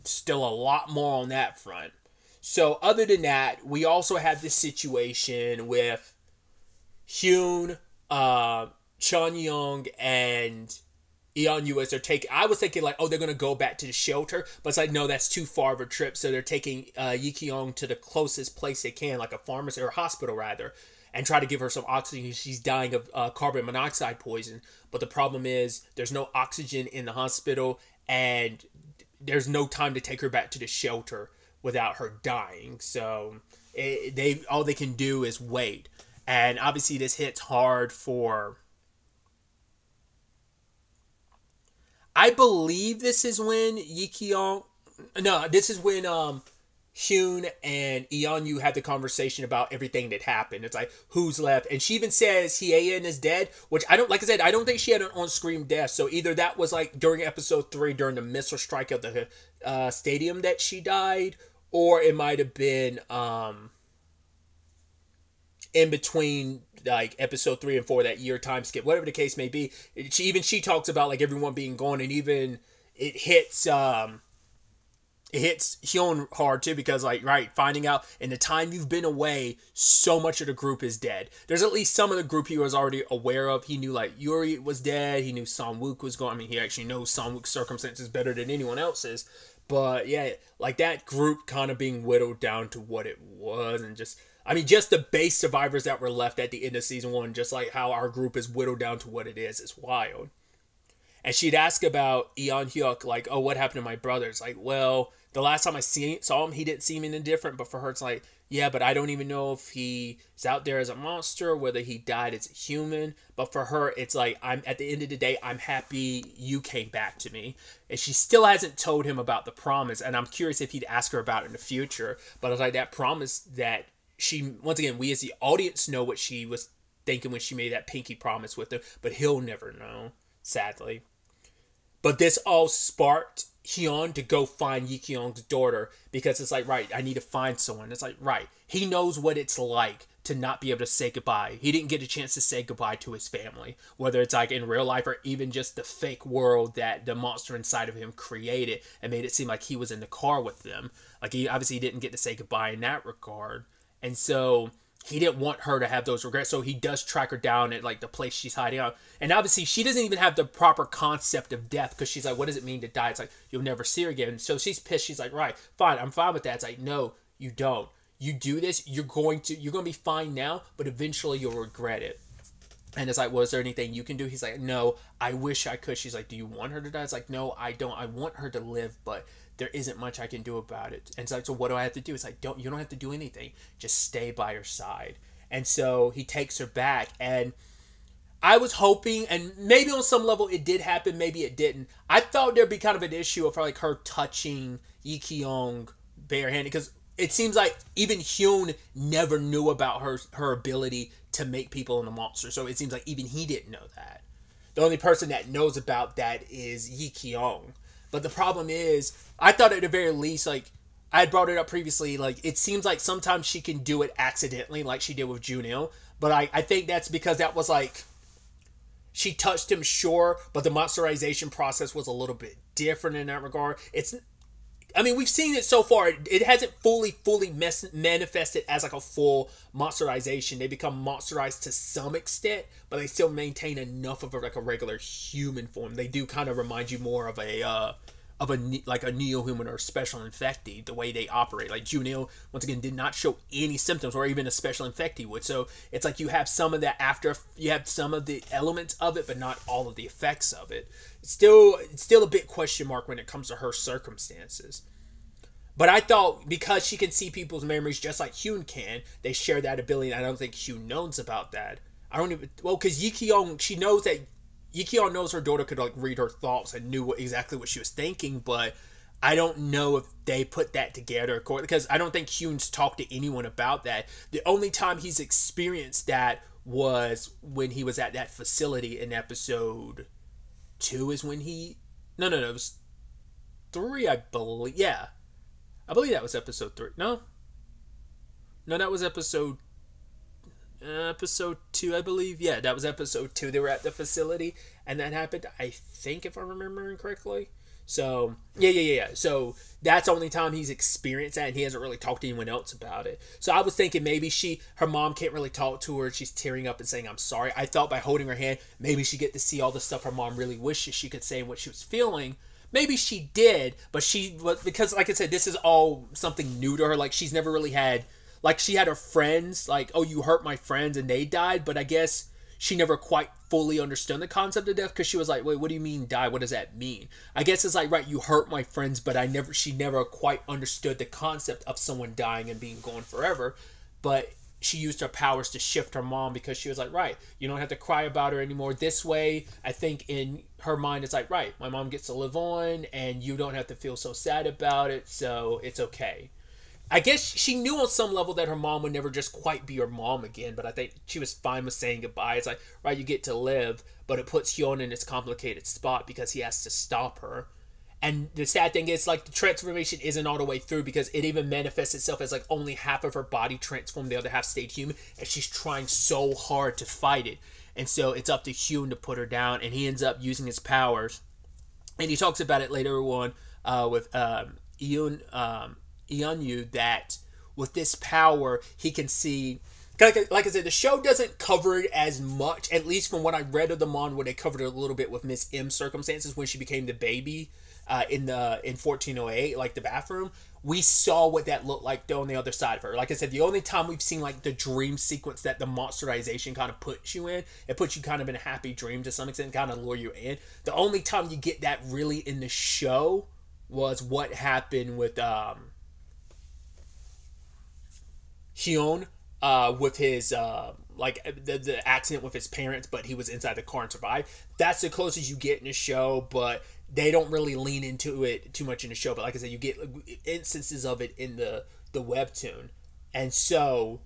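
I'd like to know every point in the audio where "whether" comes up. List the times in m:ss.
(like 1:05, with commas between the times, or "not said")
1:51, 2:23.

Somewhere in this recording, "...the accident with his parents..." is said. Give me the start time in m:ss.
6:51.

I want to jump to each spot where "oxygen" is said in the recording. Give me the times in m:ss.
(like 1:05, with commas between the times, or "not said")
0:21, 0:26.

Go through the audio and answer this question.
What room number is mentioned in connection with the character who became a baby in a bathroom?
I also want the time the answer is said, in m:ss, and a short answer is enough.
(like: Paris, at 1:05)
1408, at 6:28.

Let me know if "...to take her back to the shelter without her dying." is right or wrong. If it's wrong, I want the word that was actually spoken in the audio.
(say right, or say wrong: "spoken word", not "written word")
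right.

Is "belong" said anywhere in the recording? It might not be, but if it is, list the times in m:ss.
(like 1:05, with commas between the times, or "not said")
not said.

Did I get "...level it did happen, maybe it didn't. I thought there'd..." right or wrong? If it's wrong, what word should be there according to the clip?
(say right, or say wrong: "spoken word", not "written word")
right.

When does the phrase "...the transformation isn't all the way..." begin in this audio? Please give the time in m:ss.
5:59.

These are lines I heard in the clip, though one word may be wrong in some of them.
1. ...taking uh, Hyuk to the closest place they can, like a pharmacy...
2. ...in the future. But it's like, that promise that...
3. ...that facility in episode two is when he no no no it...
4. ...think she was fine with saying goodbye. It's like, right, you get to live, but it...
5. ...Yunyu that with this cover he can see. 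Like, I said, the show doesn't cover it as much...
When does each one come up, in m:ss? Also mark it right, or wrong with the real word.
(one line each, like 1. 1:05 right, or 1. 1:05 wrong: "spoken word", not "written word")
1. 0:16 wrong: "Yikiong", not "Hyuk"
2. 2:01 right
3. 4:38 right
4. 5:50 right
5. 6:16 wrong: "power", not "cover".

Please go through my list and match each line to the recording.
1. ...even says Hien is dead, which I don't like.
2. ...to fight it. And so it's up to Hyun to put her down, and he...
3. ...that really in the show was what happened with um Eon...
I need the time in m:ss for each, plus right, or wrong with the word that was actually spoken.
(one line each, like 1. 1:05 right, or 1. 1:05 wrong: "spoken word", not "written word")
1. 0:51 right
2. 6:06 right
3. 6:41 wrong: "Hyun", not "Eon".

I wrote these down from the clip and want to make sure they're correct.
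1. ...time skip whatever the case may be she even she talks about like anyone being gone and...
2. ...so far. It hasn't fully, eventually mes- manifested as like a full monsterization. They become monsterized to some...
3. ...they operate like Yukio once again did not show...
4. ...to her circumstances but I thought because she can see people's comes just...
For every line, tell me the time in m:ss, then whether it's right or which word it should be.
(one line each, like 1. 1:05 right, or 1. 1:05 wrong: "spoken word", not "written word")
1. 1:08 wrong: "everyone", not "anyone"
2. 3:45 wrong: "fully", not "eventually"
3. 4:01 wrong: "Junio", not "Yukio"
4. 4:13 wrong: "memories", not "comes".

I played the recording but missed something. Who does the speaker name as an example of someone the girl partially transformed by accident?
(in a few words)
Junil.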